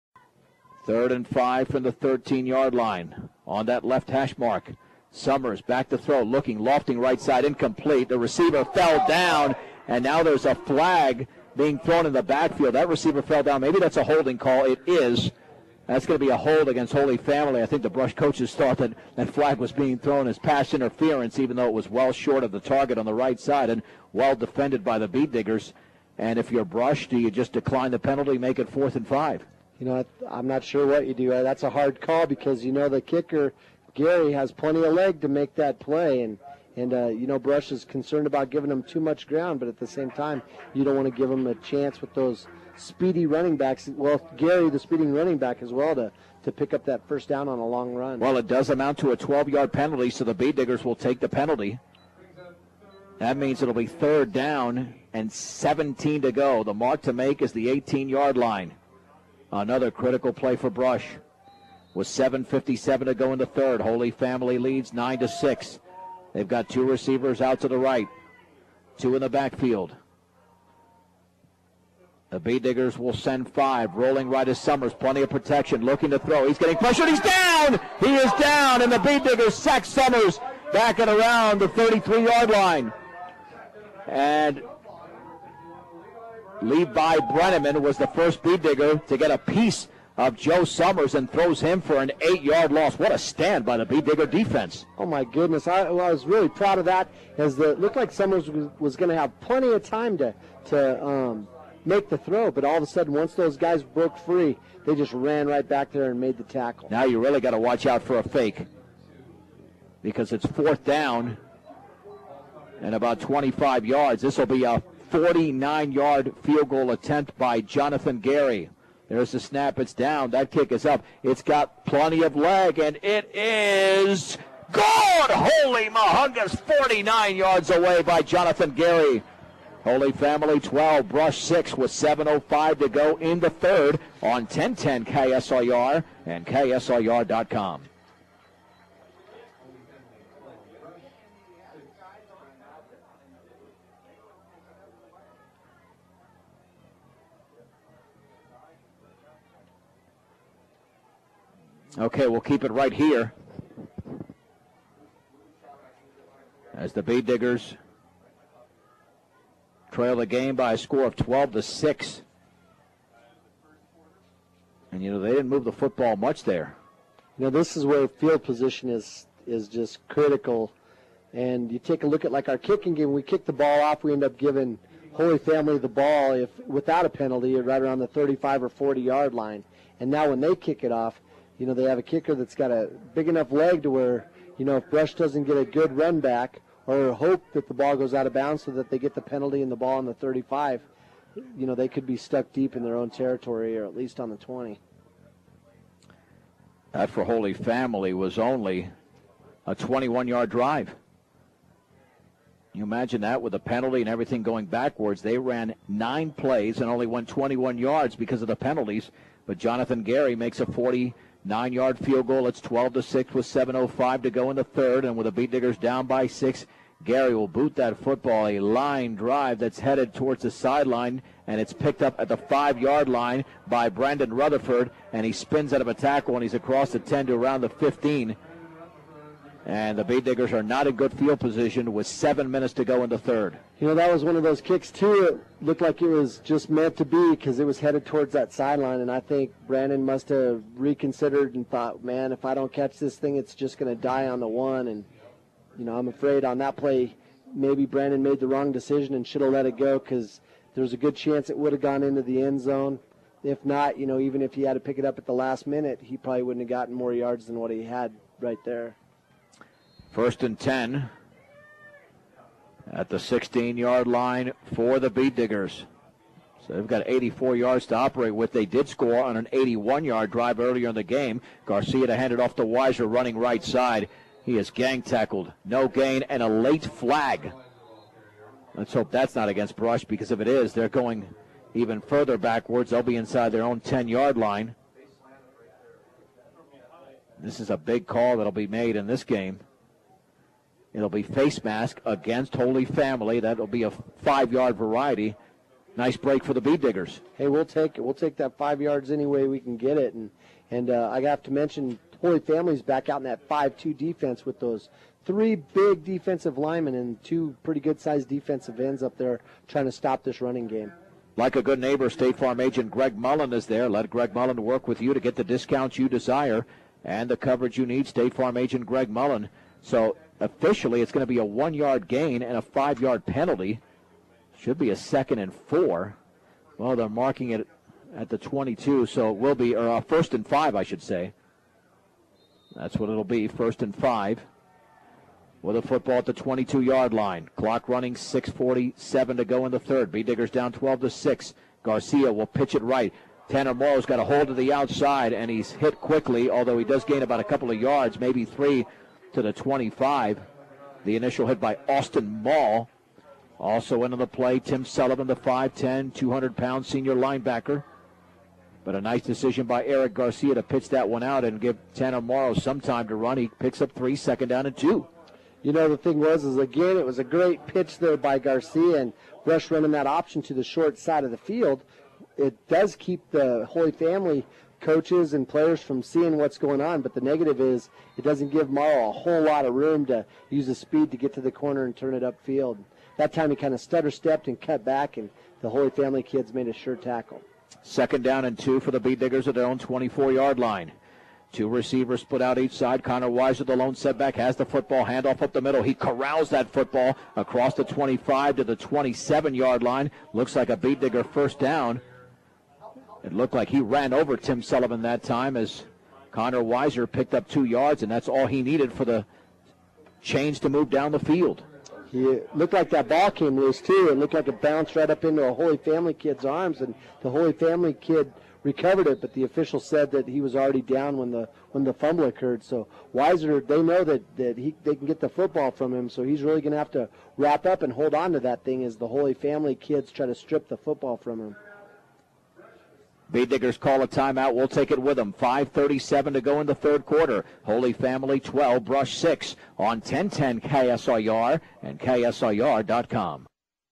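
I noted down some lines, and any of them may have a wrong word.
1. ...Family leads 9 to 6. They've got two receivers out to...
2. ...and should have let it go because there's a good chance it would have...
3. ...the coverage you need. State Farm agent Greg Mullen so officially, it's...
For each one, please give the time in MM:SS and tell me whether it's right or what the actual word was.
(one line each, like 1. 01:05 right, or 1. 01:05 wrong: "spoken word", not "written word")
1. 01:04 right
2. 04:09 right
3. 05:17 right.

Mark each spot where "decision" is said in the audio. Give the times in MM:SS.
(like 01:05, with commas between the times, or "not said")
04:08, 05:59.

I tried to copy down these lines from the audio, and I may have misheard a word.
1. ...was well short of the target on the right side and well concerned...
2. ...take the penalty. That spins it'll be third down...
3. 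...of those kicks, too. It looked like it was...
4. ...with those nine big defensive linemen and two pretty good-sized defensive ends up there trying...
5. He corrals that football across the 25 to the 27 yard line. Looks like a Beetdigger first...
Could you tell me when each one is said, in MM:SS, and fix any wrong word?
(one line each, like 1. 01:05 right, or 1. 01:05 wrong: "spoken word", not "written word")
1. 00:21 wrong: "defended", not "concerned"
2. 00:50 wrong: "means", not "spins"
3. 03:54 right
4. 05:04 wrong: "three", not "nine"
5. 06:35 right.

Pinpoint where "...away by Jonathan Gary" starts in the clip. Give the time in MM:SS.
02:07.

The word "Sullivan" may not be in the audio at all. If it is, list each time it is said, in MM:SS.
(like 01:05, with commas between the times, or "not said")
05:54, 06:44.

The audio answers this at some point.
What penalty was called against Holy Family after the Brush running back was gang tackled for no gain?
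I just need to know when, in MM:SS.
04:51.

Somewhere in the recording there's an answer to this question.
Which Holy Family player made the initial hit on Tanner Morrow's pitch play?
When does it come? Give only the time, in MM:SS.
05:51.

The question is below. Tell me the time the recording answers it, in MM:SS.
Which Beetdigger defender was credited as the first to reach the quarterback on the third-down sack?
01:26.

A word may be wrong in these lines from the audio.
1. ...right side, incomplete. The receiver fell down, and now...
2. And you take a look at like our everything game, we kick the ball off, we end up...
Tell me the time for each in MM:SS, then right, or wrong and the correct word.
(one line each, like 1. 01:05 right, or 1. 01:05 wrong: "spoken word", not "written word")
1. 00:06 right
2. 02:51 wrong: "kicking", not "everything".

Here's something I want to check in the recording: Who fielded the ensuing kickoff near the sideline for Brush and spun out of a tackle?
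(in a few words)
Brandon Rutherford.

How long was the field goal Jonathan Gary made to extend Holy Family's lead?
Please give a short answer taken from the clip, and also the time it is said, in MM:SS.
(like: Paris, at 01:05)
49 yards, at 01:55.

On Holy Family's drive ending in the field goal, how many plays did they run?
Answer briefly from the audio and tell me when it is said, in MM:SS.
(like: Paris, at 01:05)
9, at 03:25.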